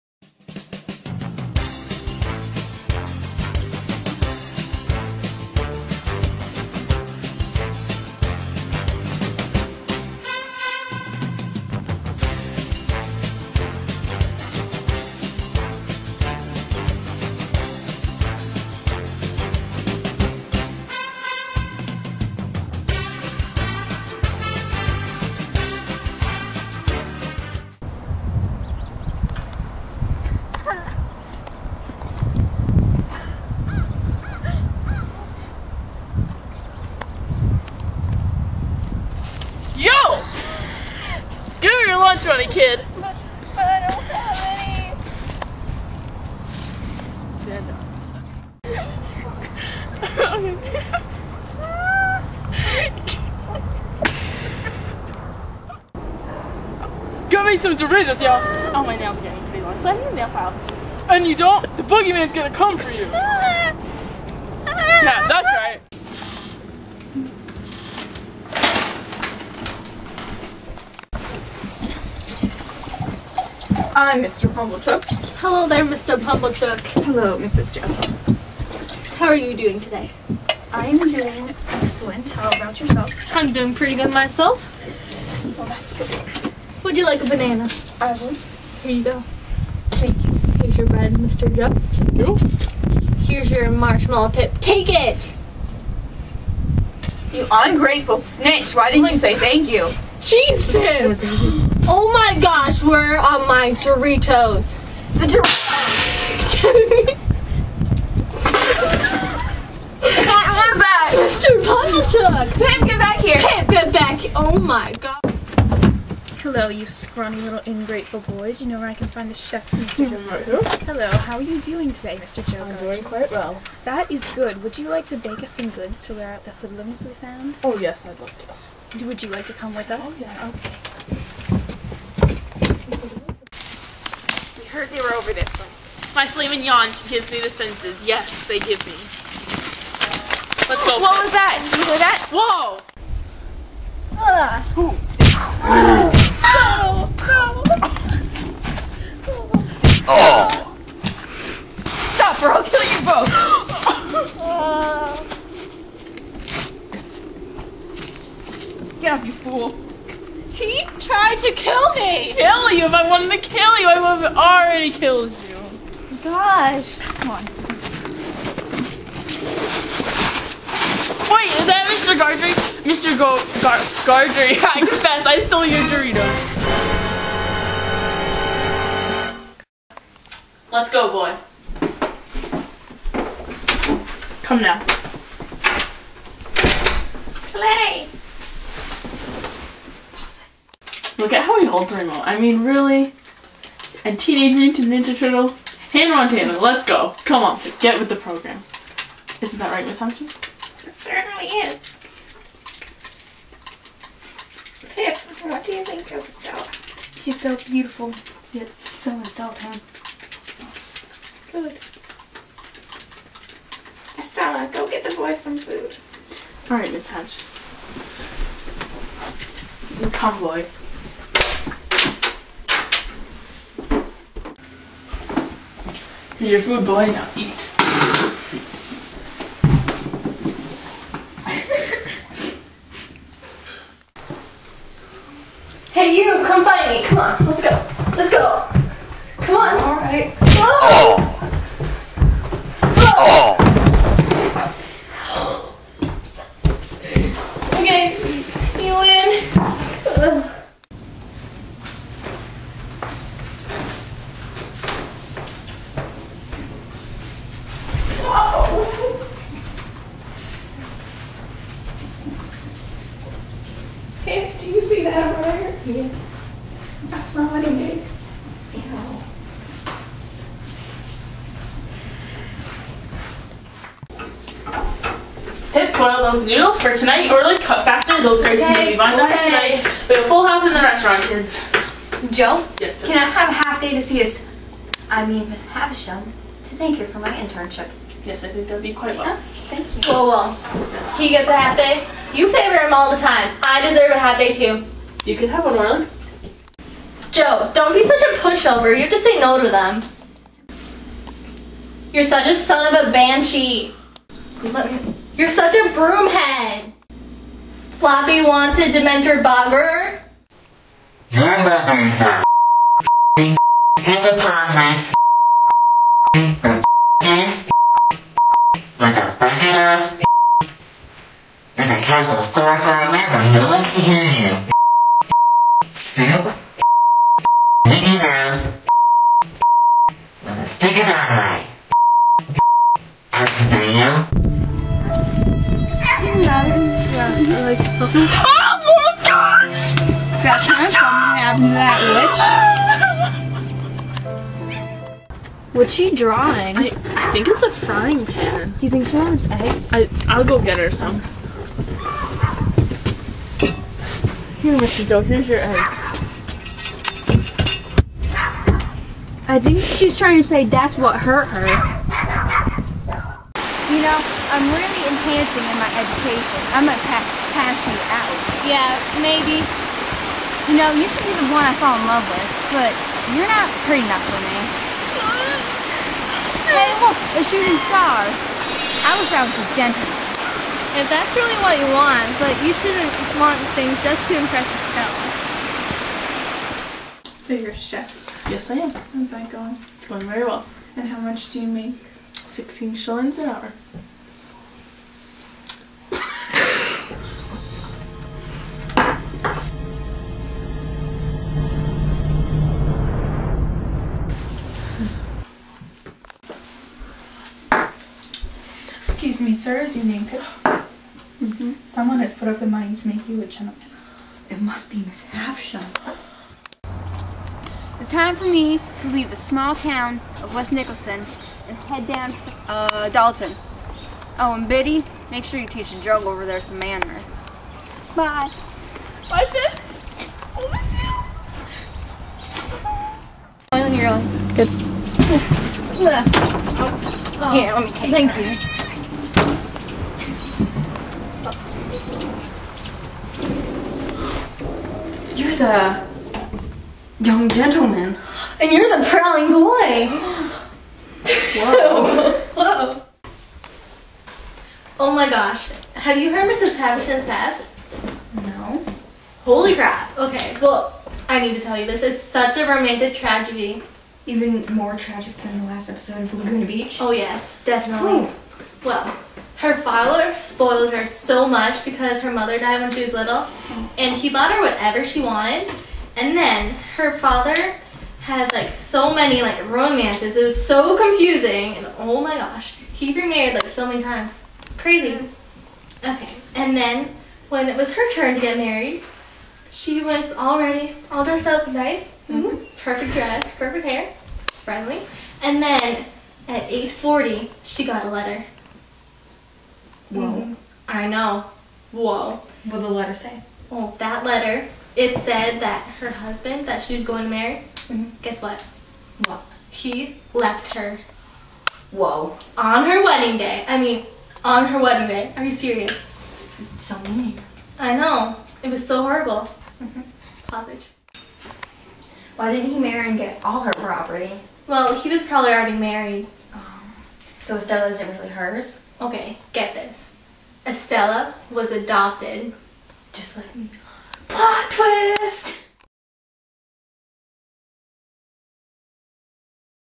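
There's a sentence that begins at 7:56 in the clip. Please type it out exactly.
And then her father had like so many like romances.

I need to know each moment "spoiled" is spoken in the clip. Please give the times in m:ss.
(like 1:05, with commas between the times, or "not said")
7:50.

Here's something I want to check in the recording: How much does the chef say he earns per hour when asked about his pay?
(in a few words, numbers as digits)
16 shillings.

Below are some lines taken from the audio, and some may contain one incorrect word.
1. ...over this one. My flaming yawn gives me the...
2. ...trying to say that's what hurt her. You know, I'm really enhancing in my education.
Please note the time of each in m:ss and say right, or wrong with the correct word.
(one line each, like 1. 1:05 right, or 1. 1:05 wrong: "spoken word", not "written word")
1. 2:15 right
2. 6:00 right.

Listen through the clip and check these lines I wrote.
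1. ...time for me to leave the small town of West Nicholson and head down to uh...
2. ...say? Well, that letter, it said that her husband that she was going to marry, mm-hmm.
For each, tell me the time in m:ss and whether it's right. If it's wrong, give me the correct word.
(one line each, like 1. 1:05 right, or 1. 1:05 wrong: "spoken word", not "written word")
1. 6:58 right
2. 8:23 right.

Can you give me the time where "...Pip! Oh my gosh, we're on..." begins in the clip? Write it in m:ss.
1:40.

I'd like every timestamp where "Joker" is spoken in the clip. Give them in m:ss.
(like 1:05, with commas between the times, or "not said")
2:02.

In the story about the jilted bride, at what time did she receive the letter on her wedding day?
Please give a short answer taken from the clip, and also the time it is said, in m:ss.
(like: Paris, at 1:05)
8:40, at 8:16.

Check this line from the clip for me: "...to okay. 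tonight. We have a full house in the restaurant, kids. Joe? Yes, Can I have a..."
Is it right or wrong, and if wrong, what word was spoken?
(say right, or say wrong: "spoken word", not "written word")
right.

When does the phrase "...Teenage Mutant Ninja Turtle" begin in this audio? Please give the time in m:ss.
3:14.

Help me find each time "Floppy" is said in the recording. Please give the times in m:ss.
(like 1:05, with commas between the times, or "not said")
5:07.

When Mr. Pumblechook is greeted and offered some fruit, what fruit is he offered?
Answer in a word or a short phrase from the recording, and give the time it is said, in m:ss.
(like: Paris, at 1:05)
Banana, at 1:26.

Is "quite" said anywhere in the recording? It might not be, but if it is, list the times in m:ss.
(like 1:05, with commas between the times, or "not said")
2:03, 4:48.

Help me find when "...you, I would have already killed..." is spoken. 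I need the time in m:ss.
2:43.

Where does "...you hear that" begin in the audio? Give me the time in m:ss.
2:21.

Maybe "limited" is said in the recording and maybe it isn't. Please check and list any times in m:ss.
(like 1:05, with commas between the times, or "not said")
not said.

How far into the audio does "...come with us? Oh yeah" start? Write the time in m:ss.
2:09.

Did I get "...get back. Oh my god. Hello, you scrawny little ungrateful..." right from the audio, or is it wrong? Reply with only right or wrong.
wrong.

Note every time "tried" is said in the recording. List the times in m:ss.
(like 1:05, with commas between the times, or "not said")
2:41.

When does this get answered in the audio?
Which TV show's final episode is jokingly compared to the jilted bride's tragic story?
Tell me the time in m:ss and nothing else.
7:46.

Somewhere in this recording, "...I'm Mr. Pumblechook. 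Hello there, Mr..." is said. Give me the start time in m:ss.
1:14.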